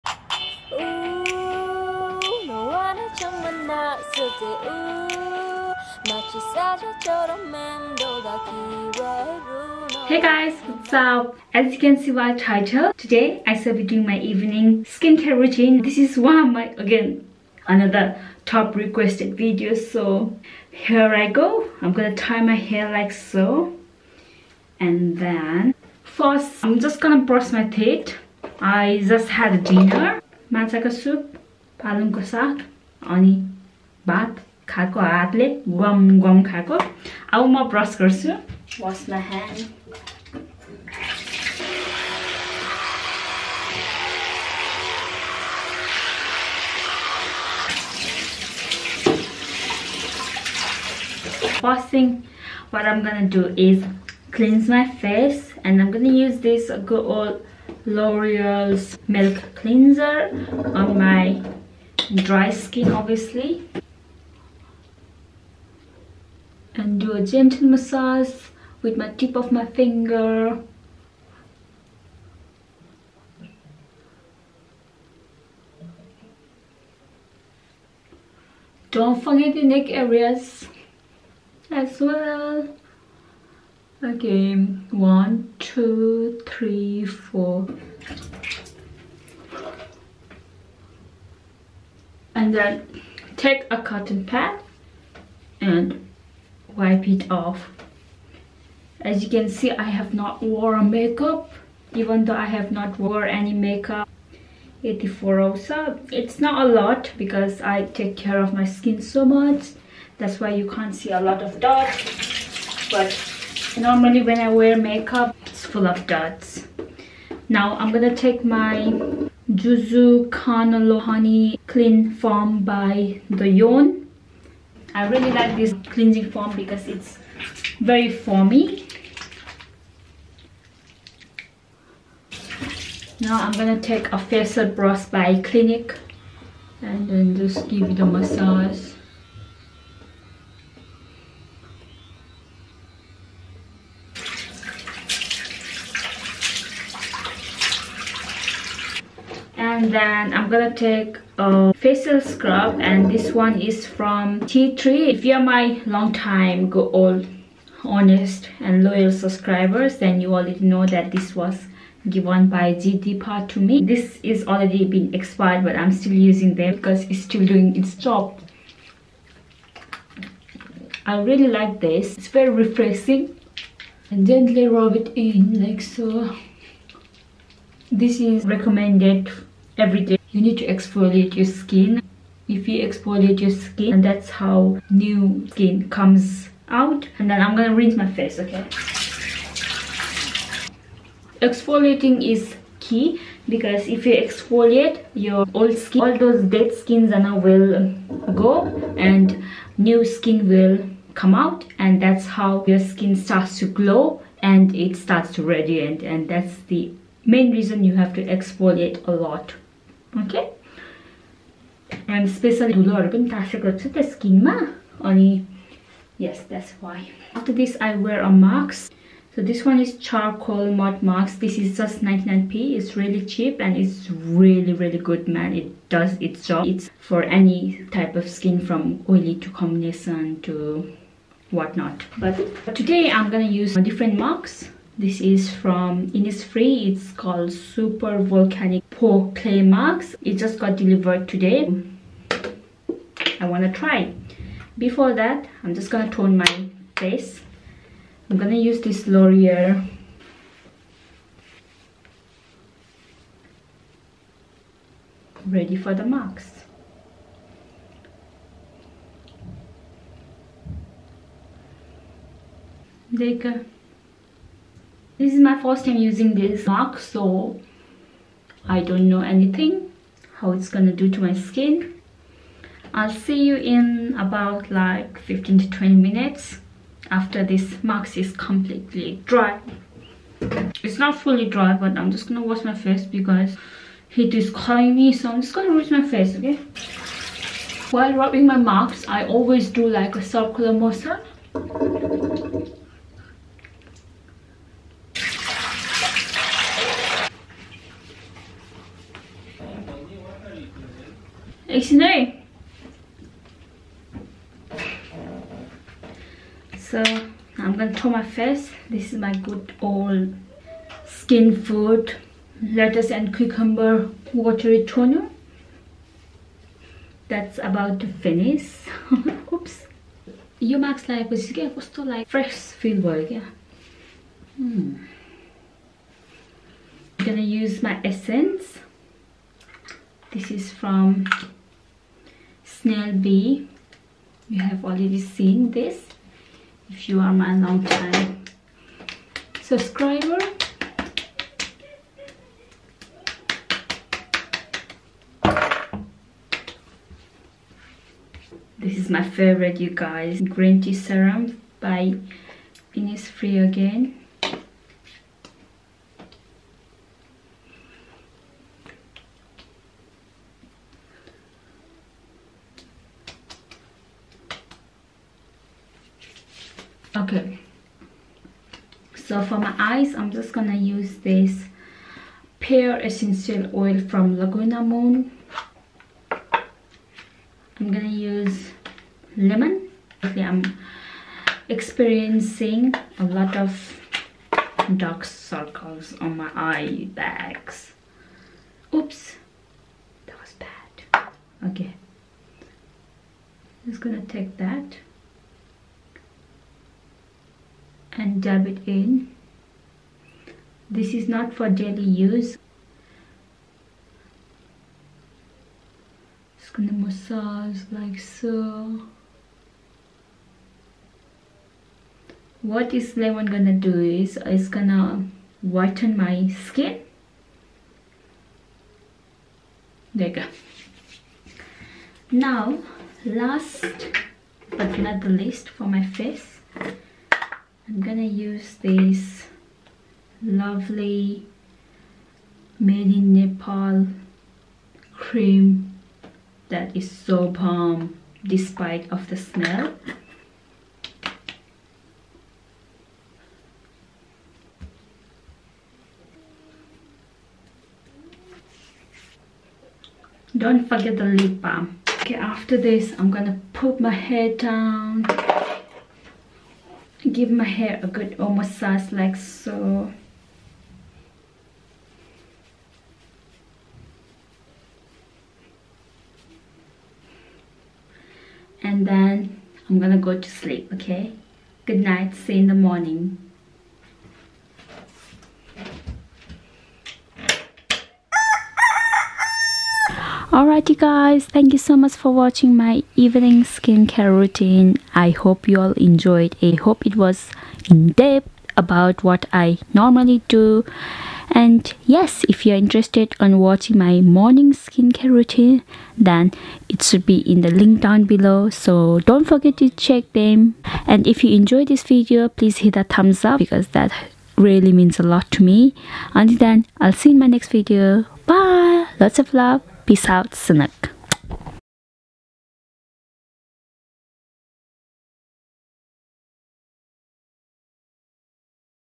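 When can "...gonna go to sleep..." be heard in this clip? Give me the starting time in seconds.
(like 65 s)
469 s.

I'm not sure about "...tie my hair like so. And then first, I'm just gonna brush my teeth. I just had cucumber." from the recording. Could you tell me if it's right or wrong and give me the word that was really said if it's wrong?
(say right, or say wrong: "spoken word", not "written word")
wrong: "dinner", not "cucumber".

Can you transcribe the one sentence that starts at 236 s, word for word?
It's called Super Volcanic Pore Clay Marks.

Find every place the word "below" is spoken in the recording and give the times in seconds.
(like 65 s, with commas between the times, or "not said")
498 s.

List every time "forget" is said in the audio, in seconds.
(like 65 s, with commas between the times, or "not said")
79 s, 450 s, 499 s.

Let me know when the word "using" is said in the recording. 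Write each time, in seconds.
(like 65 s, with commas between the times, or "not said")
166 s, 265 s.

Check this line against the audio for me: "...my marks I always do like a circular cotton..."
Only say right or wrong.
wrong.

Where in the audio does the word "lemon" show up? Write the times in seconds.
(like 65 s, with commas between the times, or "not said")
379 s, 413 s.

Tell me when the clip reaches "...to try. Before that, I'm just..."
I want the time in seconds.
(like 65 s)
243 s.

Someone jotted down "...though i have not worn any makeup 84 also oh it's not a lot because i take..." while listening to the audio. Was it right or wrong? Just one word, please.
right.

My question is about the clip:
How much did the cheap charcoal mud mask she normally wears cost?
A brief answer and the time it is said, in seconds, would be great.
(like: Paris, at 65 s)
99p, at 222 s.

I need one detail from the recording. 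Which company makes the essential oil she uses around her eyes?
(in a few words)
Laguna Moon.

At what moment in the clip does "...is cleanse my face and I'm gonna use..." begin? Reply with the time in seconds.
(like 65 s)
53 s.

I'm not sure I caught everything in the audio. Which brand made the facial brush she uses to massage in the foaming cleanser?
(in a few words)
Clinique.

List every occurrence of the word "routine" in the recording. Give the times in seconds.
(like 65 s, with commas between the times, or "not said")
15 s, 484 s, 495 s.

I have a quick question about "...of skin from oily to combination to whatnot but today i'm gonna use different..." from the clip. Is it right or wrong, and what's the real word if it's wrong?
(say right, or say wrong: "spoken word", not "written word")
right.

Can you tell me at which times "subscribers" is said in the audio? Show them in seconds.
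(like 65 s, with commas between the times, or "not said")
159 s, 339 s.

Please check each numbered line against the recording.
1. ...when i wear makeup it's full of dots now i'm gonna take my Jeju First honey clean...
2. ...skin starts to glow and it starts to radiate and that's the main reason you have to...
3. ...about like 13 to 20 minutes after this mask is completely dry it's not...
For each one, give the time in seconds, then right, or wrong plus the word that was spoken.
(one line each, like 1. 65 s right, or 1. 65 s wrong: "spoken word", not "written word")
1. 114 s wrong: "Canola", not "First"
2. 202 s right
3. 274 s wrong: "15", not "13".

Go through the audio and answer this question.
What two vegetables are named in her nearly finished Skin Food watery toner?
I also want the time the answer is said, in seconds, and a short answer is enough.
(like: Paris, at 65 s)
lettuce and cucumber, at 312 s.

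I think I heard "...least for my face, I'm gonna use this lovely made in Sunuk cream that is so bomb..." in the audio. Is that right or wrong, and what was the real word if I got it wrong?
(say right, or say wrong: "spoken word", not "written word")
wrong: "Nepal", not "Sunuk".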